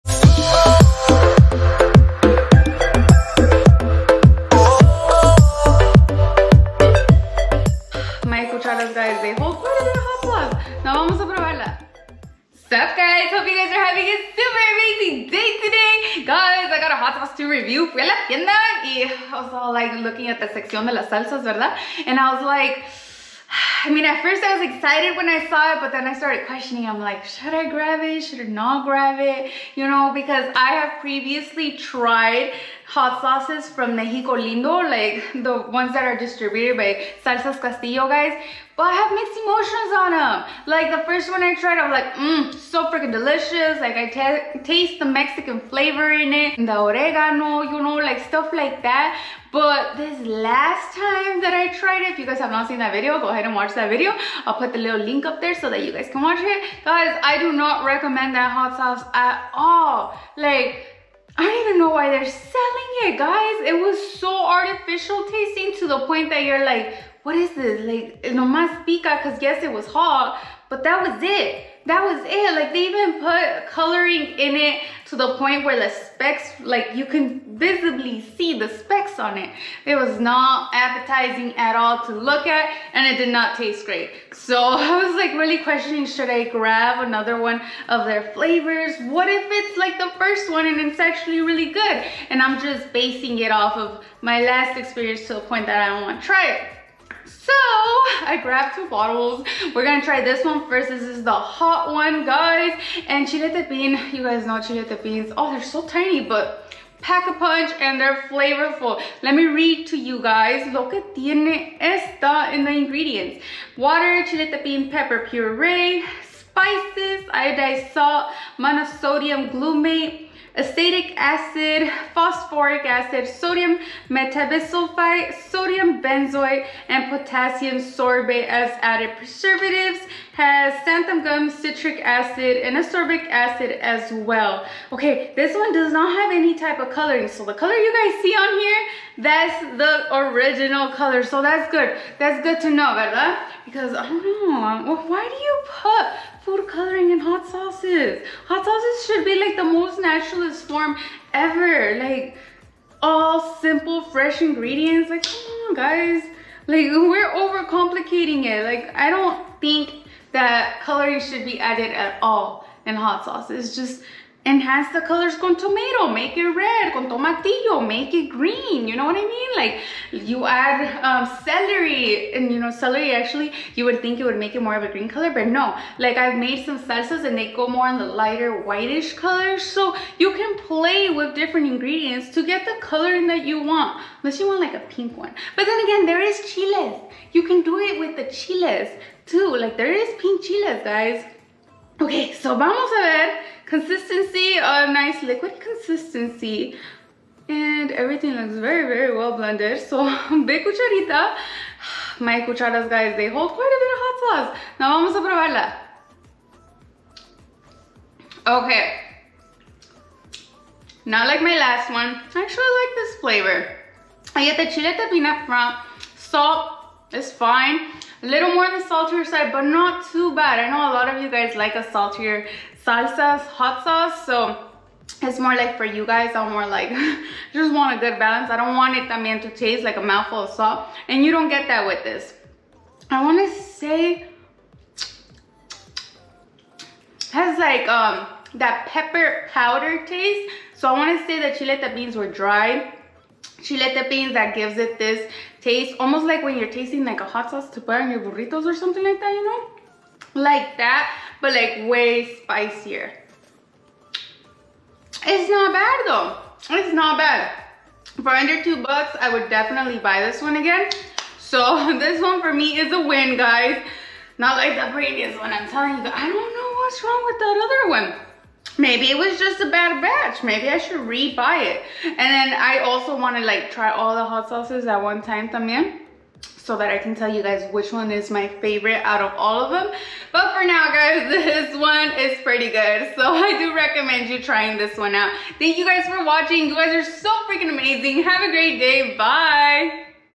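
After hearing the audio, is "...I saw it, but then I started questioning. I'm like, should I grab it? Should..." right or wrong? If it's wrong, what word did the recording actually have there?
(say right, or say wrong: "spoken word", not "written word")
right.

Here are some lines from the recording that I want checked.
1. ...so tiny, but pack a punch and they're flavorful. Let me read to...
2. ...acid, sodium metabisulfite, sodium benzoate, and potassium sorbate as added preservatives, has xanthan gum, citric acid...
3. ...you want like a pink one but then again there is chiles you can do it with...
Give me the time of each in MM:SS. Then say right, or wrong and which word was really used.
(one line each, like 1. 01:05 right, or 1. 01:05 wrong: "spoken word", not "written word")
1. 01:45 right
2. 02:02 right
3. 03:04 right.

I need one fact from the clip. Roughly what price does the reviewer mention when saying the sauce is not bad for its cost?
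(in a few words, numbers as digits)
Under 2 dollars.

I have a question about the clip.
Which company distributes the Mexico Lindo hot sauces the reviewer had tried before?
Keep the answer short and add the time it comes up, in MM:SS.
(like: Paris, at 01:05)
Salsas Castillo, at 00:37.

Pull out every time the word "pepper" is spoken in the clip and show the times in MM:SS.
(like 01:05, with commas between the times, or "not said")
01:54, 03:58.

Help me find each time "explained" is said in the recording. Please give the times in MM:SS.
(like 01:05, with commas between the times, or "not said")
not said.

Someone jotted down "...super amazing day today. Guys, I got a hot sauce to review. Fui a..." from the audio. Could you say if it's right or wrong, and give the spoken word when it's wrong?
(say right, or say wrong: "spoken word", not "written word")
right.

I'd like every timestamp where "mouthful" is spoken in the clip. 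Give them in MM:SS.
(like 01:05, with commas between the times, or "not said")
03:50.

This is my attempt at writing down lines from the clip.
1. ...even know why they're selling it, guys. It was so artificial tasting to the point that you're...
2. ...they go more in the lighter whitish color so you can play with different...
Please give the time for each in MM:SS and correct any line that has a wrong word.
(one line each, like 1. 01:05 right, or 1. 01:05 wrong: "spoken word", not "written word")
1. 01:01 right
2. 02:57 right.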